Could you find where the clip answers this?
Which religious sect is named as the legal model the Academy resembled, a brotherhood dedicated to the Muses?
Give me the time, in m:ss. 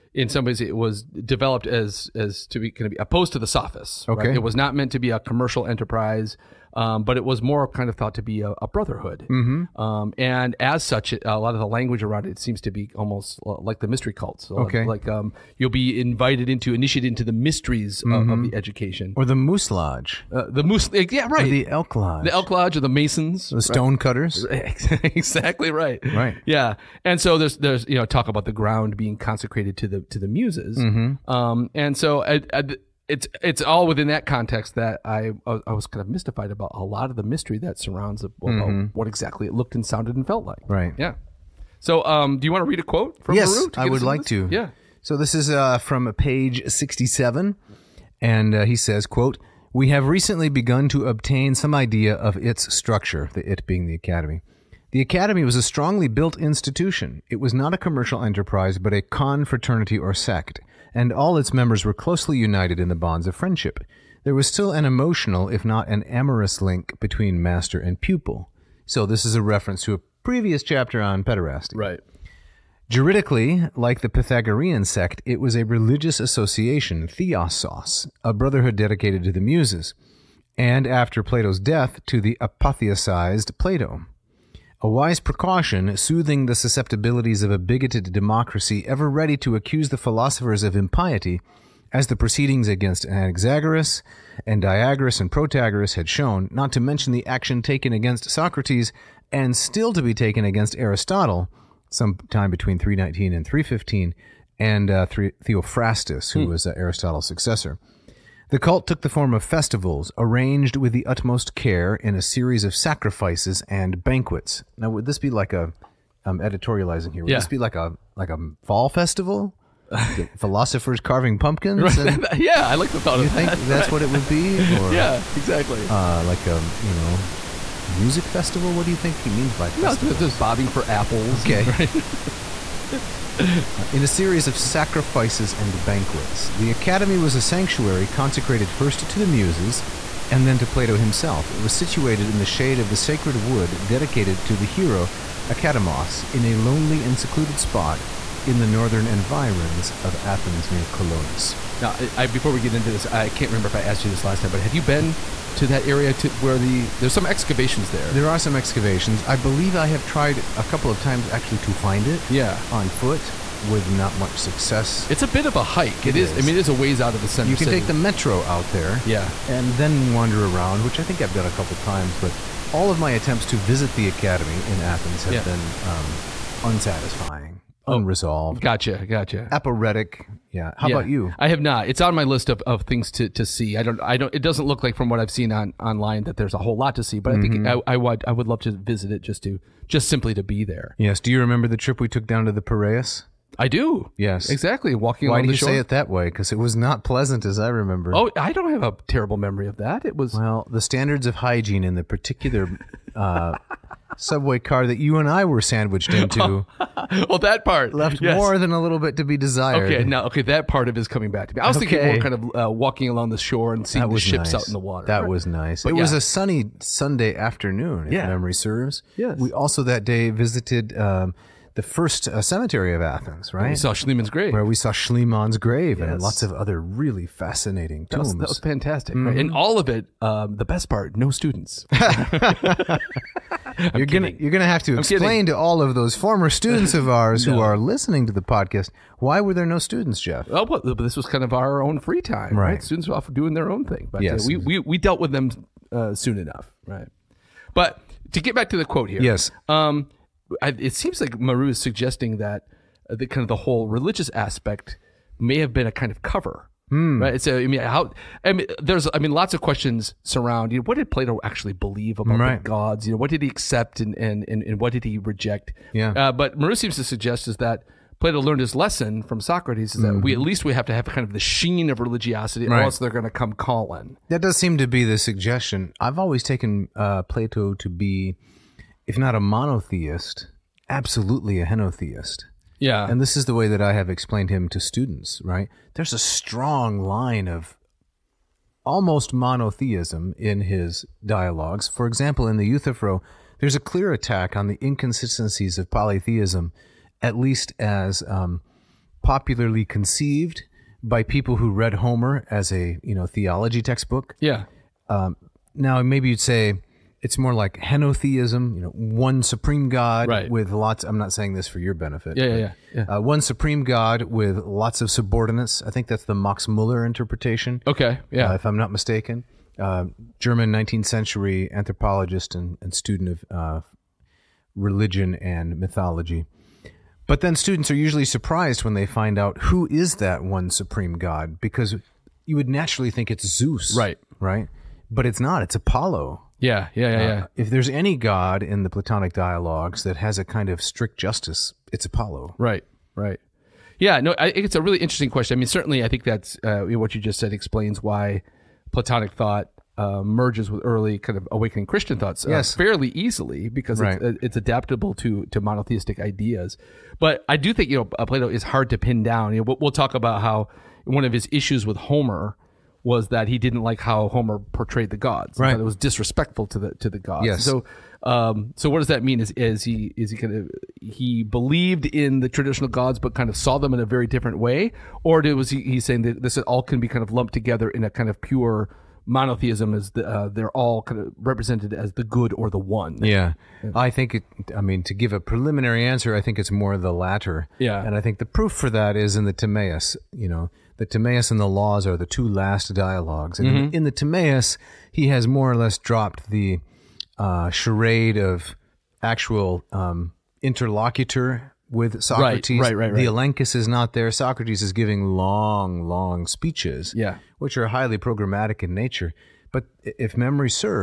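1:14.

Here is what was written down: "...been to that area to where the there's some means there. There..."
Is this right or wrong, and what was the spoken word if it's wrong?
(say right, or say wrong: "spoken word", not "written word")
wrong: "excavations", not "means".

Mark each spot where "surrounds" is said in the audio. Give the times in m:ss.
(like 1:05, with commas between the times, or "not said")
0:37, 4:20.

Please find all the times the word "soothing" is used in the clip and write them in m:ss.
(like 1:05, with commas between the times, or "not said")
1:25.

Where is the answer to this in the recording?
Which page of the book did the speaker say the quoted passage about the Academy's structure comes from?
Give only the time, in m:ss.
0:46.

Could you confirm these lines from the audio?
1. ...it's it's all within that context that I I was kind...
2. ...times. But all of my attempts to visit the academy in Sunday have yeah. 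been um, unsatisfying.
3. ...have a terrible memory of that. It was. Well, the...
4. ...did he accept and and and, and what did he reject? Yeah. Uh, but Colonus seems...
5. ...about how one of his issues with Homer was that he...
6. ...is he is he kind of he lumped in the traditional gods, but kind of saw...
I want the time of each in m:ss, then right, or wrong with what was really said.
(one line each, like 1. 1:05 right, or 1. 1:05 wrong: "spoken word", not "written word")
1. 0:33 right
2. 2:51 wrong: "Athens", not "Sunday"
3. 3:18 right
4. 4:23 wrong: "Marrou", not "Colonus"
5. 6:00 right
6. 6:09 wrong: "believed", not "lumped".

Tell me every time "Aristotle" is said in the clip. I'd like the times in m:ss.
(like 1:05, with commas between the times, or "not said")
1:40, 1:46.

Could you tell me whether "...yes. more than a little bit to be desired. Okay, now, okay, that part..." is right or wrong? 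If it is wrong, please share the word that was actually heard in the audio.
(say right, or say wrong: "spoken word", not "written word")
right.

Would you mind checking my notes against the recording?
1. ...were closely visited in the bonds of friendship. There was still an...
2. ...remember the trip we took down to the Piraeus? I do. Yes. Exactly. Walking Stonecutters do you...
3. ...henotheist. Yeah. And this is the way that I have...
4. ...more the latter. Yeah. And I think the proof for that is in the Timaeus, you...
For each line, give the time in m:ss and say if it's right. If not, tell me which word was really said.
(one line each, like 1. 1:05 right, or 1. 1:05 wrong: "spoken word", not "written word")
1. 1:01 wrong: "united", not "visited"
2. 3:11 wrong: "Why", not "Stonecutters"
3. 4:41 right
4. 6:26 right.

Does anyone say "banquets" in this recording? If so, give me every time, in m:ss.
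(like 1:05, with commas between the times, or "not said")
1:54, 2:15.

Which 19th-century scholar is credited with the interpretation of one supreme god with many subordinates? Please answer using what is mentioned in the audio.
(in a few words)
Max Muller.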